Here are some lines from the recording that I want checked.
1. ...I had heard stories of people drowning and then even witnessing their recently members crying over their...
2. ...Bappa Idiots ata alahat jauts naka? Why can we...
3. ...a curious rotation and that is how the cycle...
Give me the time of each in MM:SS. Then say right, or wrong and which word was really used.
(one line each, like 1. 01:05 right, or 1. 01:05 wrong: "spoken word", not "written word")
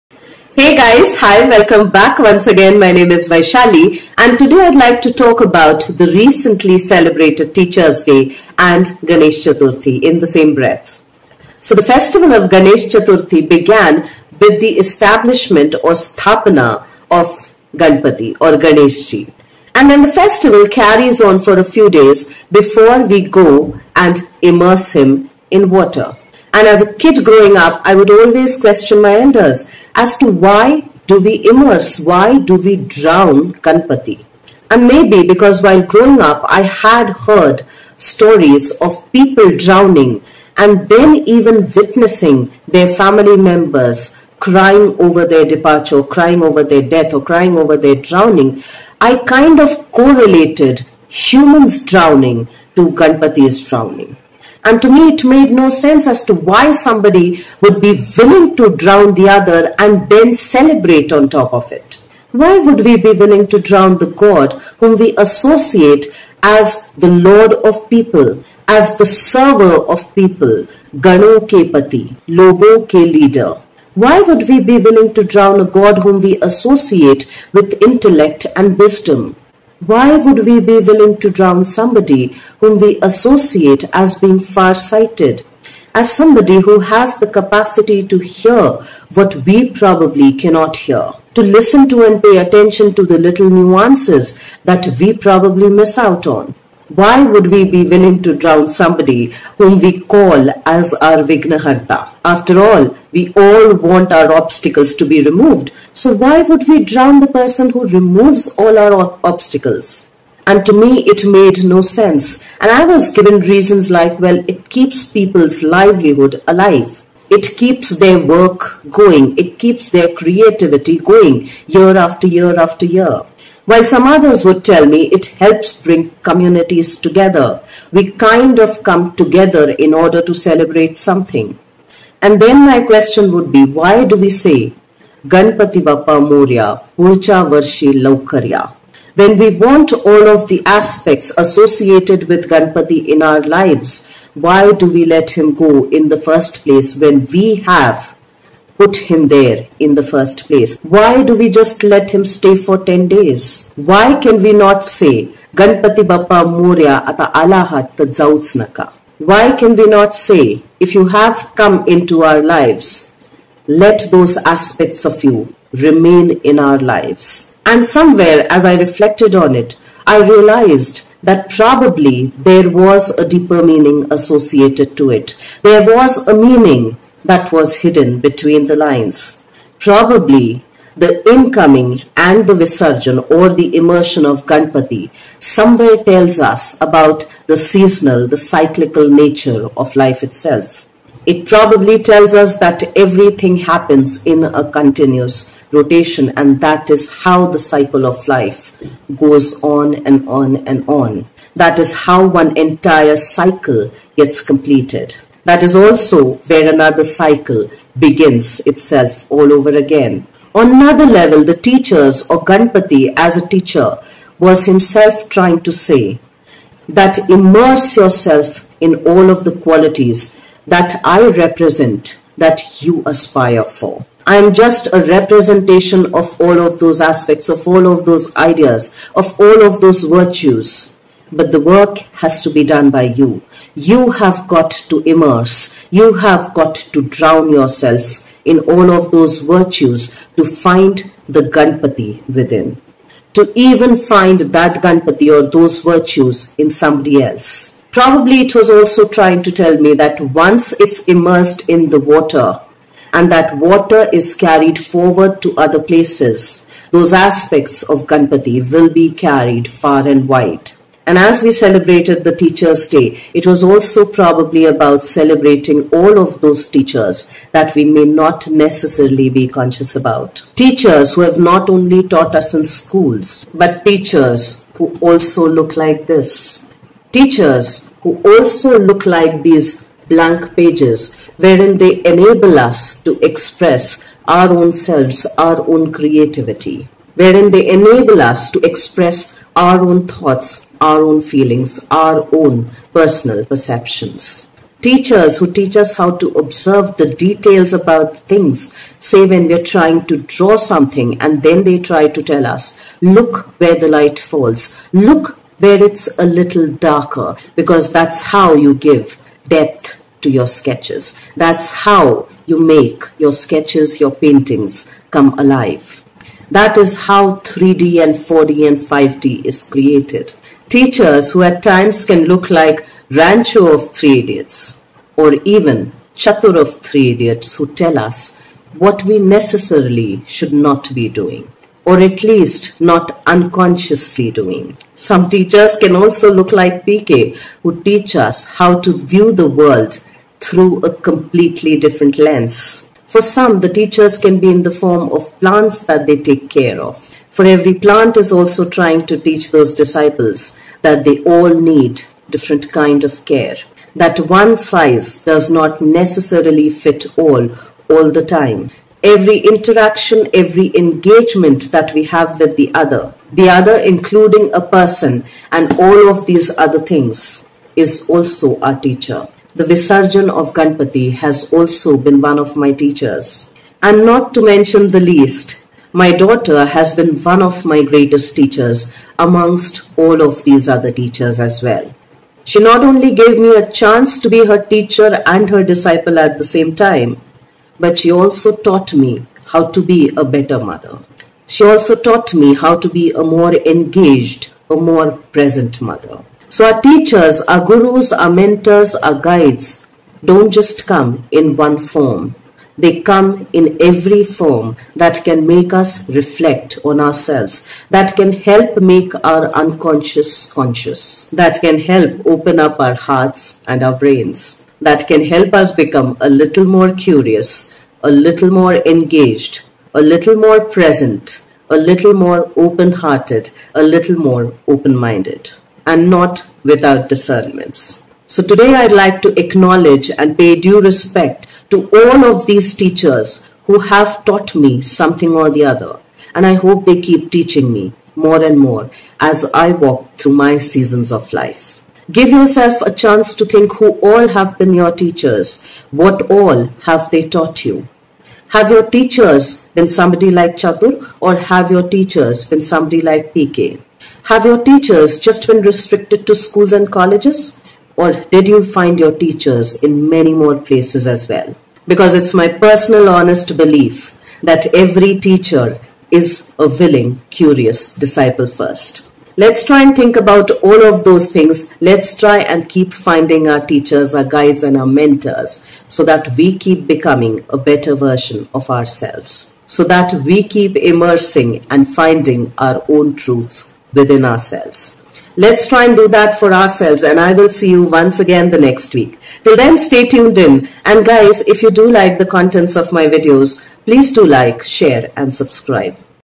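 1. 00:36 wrong: "family", not "recently"
2. 02:36 wrong: "Morya", not "Idiots"
3. 03:14 wrong: "continuous", not "curious".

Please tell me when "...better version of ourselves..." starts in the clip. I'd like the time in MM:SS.
07:57.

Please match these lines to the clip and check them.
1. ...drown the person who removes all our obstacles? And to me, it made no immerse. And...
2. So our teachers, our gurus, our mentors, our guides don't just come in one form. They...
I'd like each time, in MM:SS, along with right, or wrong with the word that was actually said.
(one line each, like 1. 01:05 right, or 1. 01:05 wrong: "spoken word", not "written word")
1. 01:46 wrong: "sense", not "immerse"
2. 06:36 right.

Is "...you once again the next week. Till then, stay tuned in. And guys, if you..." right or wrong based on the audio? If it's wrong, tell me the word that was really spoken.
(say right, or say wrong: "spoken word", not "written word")
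right.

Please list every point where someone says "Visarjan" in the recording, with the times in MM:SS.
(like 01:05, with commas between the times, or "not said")
03:02, 06:09.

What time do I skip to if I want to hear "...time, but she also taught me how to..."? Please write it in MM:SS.
06:26.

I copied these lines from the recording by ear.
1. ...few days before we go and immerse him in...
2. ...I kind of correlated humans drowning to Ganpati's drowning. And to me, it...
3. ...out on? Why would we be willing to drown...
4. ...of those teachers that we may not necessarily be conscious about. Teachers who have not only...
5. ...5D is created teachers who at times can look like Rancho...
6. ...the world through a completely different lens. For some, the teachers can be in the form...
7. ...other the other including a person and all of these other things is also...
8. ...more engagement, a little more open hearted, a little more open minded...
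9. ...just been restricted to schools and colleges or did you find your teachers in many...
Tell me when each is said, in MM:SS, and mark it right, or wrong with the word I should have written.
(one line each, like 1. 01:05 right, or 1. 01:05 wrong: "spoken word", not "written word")
1. 00:21 right
2. 00:48 right
3. 01:35 right
4. 04:26 right
5. 05:18 right
6. 05:39 right
7. 06:02 right
8. 07:00 wrong: "present", not "engagement"
9. 07:35 right.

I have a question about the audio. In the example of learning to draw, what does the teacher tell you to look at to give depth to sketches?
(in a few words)
where the light falls.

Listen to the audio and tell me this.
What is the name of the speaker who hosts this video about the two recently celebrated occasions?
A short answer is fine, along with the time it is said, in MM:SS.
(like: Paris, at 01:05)
Vaishali, at 00:03.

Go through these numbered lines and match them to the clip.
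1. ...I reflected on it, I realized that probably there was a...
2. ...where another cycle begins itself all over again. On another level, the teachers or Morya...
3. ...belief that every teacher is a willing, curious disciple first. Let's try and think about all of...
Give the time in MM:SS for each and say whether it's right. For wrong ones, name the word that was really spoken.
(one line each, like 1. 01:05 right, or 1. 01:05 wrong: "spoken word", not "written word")
1. 02:48 right
2. 03:26 wrong: "Ganpati", not "Morya"
3. 07:43 right.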